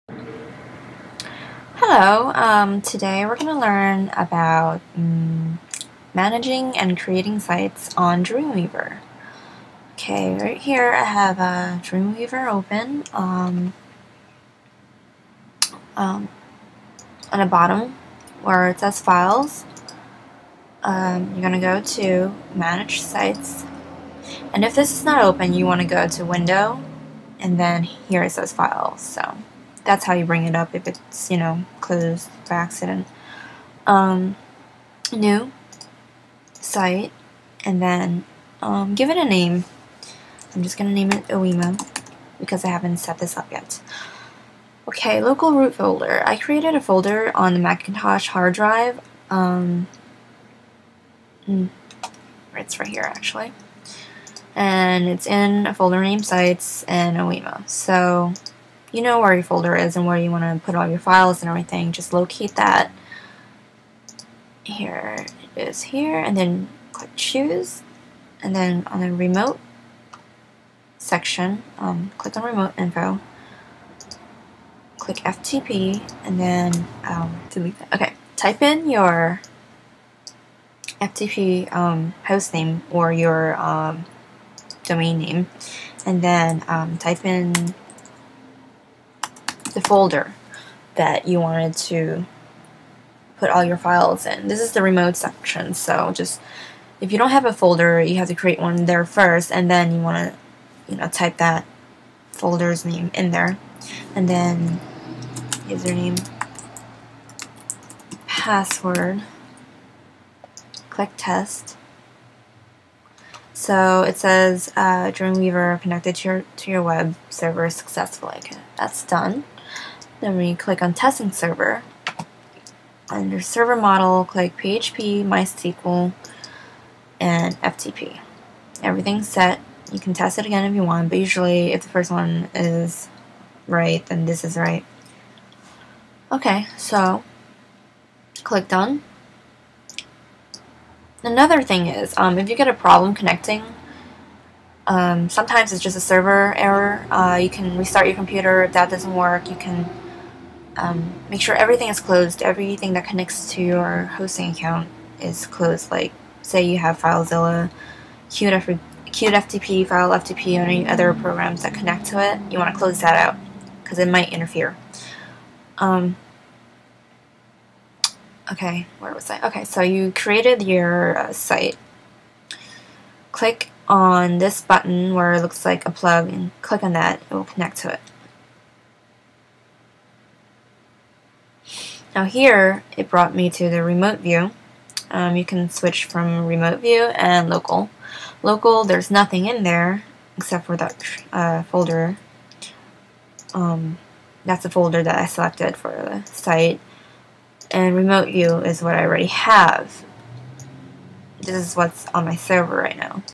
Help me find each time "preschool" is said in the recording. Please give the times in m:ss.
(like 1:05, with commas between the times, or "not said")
not said.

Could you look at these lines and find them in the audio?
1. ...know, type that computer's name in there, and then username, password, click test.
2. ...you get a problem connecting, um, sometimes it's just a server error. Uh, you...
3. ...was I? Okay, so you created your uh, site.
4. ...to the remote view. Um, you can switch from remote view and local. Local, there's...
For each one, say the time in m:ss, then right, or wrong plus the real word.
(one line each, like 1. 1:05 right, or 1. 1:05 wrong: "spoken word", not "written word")
1. 1:40 wrong: "folder", not "computer"
2. 2:22 right
3. 2:49 right
4. 3:03 right.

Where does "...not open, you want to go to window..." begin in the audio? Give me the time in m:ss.
0:25.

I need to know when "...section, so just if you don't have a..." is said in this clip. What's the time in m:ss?
1:35.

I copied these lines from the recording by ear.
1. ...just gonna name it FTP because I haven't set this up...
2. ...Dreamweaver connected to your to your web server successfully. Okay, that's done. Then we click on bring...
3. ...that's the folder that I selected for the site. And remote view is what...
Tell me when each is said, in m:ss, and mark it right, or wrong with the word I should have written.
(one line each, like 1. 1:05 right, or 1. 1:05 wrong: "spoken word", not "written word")
1. 0:40 wrong: "Oema", not "FTP"
2. 1:55 wrong: "testing", not "bring"
3. 3:14 right.